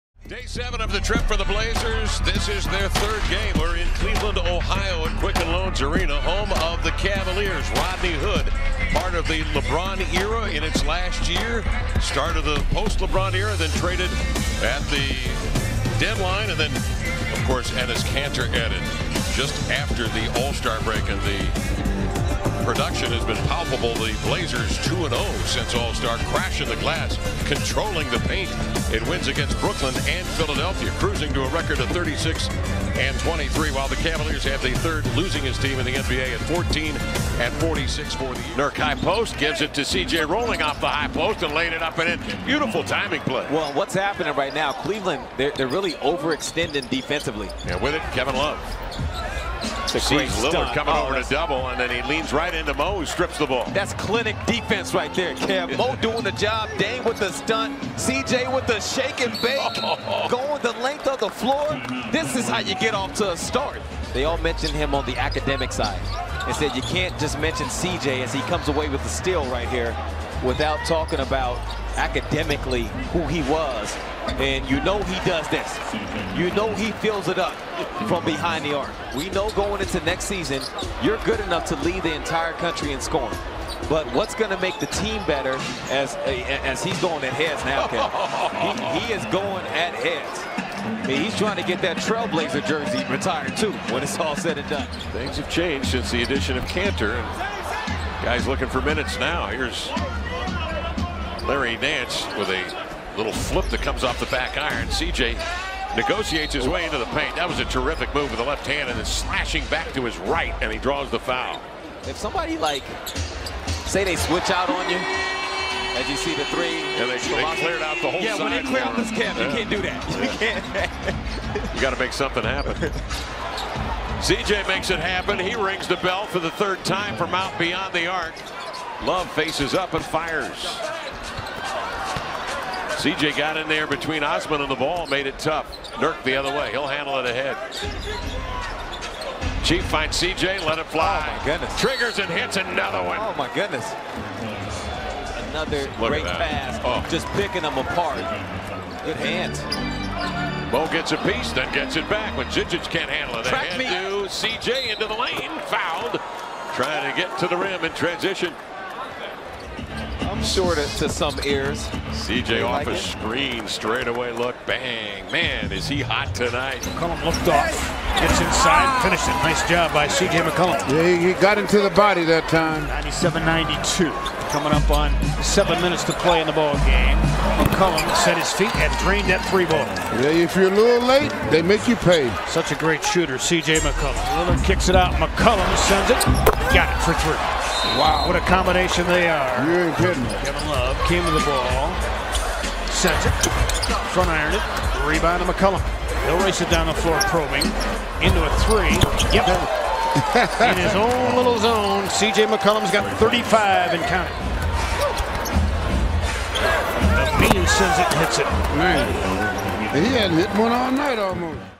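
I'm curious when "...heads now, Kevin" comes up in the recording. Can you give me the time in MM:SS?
01:27.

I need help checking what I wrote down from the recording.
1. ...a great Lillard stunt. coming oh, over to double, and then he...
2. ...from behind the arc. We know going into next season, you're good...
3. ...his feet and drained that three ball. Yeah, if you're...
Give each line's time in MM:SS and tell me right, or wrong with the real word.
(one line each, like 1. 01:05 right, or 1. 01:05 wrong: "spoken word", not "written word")
1. 00:50 right
2. 01:18 right
3. 02:58 right.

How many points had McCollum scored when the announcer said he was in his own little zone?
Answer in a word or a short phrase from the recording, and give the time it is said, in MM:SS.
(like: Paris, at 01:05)
35, at 03:23.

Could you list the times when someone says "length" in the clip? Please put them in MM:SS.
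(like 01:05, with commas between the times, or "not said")
01:00.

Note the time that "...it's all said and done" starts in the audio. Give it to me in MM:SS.
01:34.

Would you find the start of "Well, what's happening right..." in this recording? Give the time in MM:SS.
00:43.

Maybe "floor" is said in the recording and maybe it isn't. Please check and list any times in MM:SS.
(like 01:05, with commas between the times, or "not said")
01:01, 03:16.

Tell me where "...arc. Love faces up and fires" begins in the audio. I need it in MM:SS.
02:08.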